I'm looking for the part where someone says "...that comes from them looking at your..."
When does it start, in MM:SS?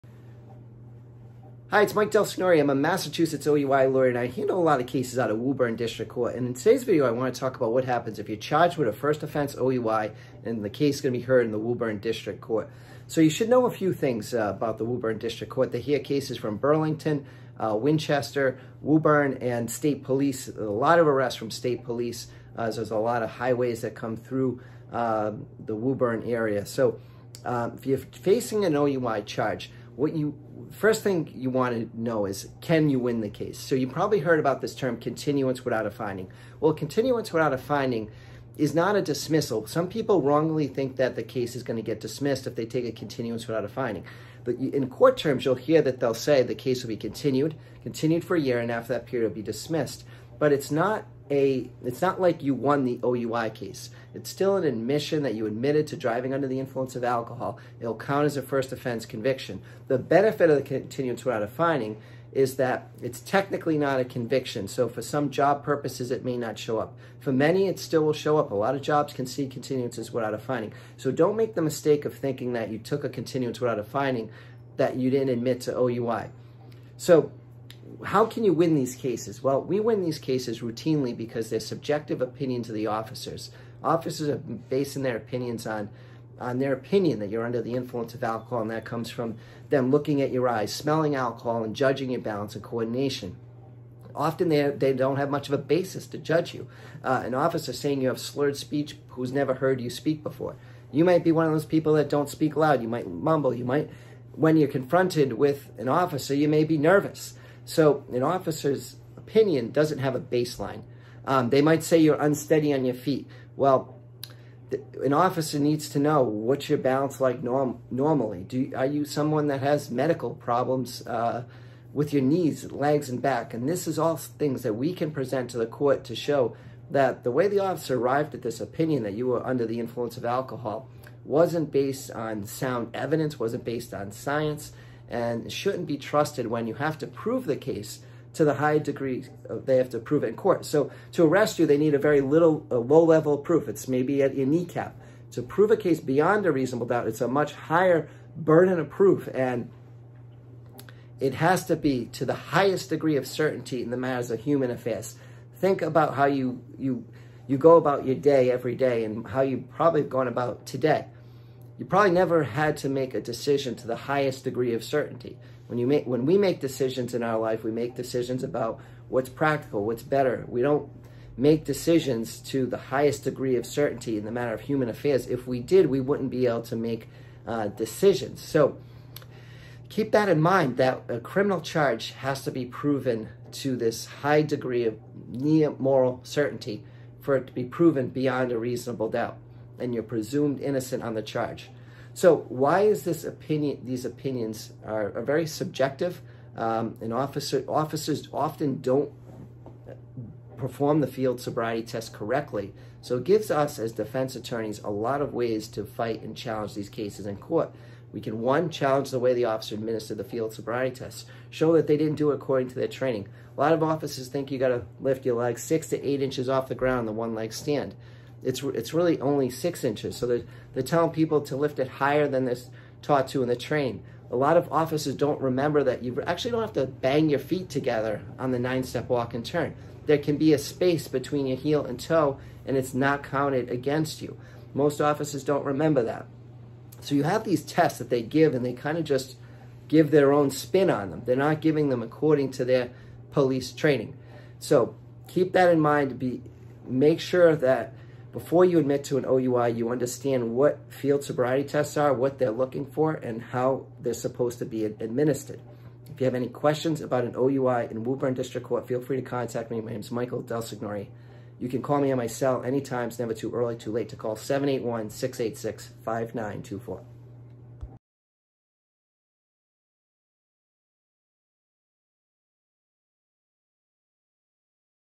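01:28.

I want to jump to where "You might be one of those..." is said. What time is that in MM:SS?
01:40.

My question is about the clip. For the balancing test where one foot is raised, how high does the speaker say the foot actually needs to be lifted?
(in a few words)
6 inches.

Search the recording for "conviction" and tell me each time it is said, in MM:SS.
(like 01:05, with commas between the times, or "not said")
00:59, 01:04.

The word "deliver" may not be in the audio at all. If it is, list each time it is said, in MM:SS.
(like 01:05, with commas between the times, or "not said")
not said.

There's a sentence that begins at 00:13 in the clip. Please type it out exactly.
So you should know a few things uh, about the Woburn District Court.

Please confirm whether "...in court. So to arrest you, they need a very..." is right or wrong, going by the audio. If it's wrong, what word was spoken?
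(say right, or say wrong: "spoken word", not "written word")
right.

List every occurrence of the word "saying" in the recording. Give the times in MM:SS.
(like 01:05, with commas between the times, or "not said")
01:37.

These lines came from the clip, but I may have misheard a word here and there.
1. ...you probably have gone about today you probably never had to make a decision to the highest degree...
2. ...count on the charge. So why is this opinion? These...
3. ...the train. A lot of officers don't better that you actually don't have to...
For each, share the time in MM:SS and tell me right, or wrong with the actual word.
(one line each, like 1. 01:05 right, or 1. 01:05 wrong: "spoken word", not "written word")
1. 02:39 right
2. 03:10 wrong: "innocent", not "count"
3. 03:43 wrong: "remember", not "better".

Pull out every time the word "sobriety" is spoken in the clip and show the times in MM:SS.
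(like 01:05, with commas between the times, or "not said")
03:21, 03:30, 04:11.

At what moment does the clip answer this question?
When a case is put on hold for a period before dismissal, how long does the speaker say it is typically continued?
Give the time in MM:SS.
00:48.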